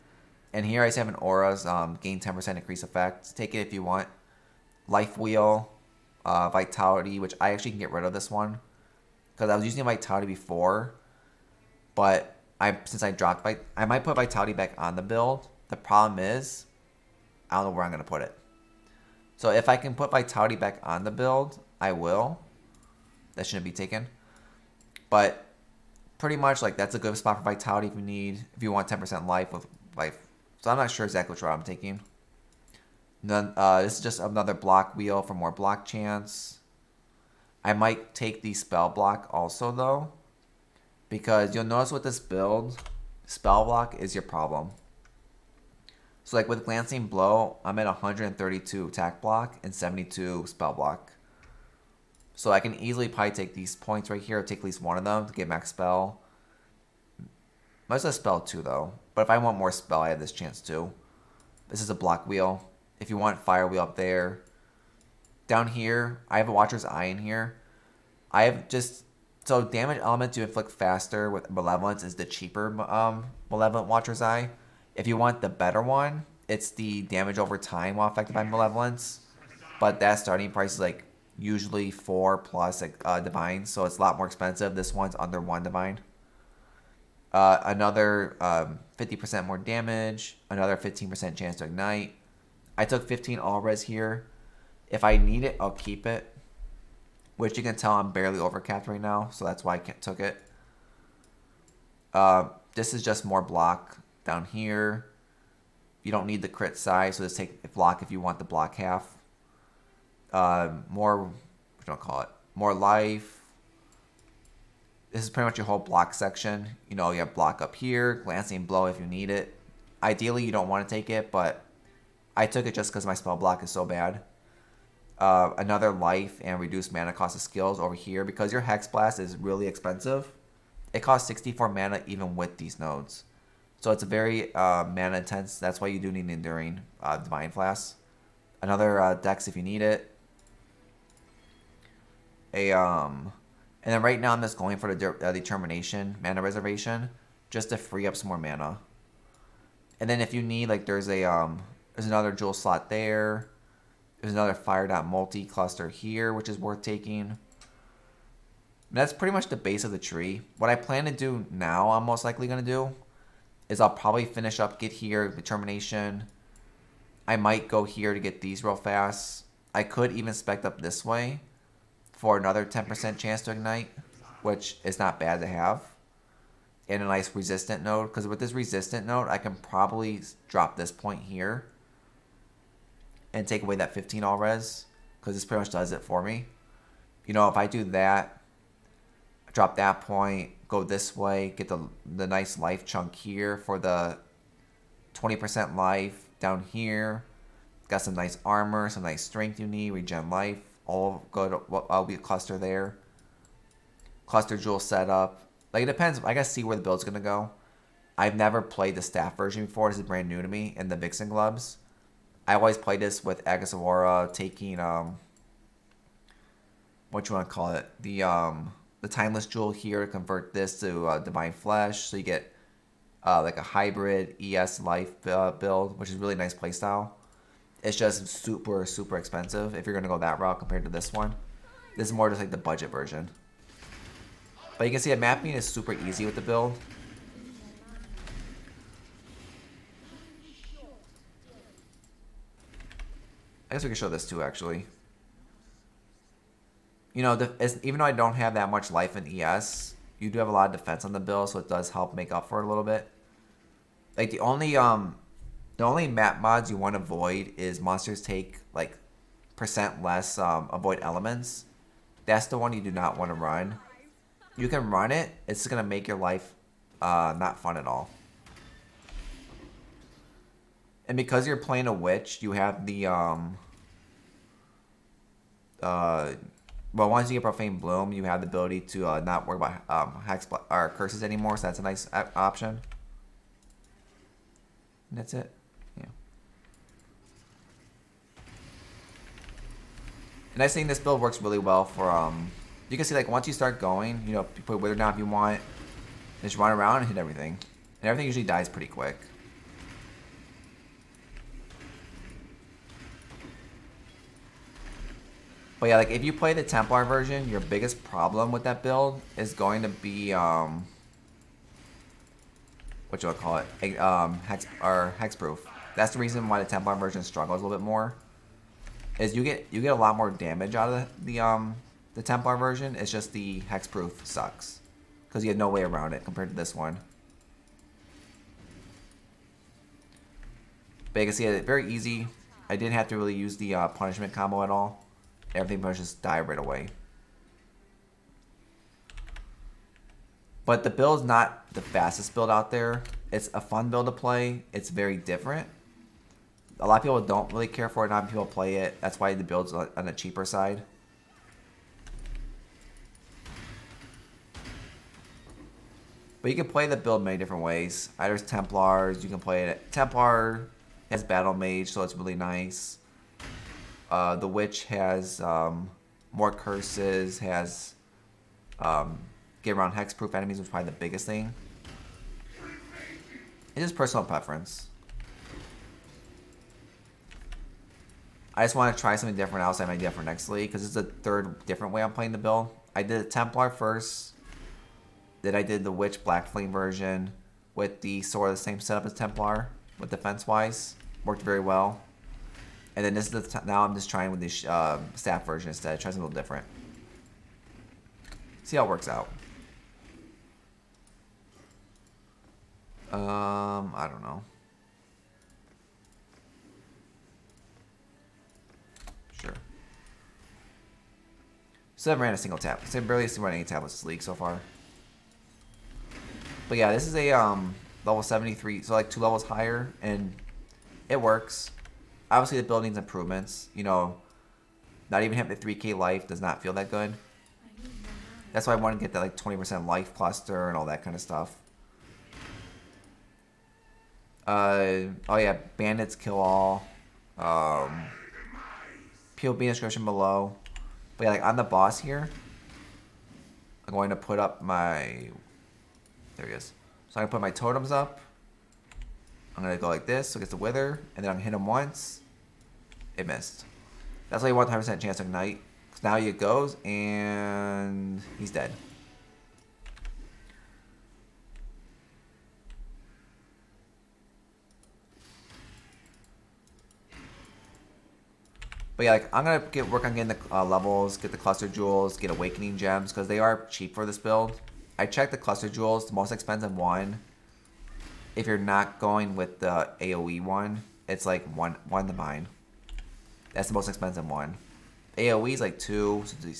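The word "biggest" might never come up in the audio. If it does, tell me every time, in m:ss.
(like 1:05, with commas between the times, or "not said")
5:07, 6:10.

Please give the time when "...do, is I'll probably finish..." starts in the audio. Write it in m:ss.
2:42.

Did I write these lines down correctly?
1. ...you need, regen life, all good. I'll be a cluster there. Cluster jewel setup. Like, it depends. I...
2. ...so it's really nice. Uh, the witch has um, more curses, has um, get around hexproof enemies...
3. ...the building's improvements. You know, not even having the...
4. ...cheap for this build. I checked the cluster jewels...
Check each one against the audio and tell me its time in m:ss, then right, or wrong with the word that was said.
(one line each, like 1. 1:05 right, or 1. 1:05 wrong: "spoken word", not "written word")
1. 3:19 right
2. 6:01 right
3. 7:02 right
4. 7:53 right.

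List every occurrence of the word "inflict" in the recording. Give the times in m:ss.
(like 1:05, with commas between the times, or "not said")
1:10.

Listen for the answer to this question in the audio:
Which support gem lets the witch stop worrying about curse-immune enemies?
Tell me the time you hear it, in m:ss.
4:37.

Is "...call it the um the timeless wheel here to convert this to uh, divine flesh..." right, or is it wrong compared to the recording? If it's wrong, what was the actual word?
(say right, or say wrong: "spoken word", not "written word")
wrong: "jewel", not "wheel".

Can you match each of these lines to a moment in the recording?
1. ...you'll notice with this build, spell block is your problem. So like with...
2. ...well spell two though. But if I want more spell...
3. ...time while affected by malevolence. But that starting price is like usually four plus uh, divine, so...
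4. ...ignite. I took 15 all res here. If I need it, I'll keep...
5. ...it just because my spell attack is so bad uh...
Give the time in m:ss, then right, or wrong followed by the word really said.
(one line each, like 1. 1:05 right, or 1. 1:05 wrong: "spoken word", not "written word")
1. 0:41 right
2. 0:58 right
3. 1:17 right
4. 1:31 right
5. 2:02 wrong: "block", not "attack".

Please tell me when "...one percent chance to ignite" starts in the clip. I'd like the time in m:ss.
7:34.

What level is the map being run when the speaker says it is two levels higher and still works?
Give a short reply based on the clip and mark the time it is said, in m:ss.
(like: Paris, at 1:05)
73, at 6:58.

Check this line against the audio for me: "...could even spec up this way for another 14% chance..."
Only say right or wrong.
wrong.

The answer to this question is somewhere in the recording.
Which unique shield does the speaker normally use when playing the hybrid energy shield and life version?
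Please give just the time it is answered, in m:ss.
3:33.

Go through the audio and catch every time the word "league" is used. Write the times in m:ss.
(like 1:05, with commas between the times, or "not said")
6:20, 6:54.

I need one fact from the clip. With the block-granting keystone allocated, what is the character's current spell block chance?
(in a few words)
72.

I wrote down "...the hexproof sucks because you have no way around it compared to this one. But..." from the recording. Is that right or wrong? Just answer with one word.
right.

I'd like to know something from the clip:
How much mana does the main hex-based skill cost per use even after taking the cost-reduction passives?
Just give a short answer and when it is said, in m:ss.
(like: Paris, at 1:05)
64 mana, at 2:11.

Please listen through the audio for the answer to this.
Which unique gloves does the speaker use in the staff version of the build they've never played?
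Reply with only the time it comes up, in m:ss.
3:30.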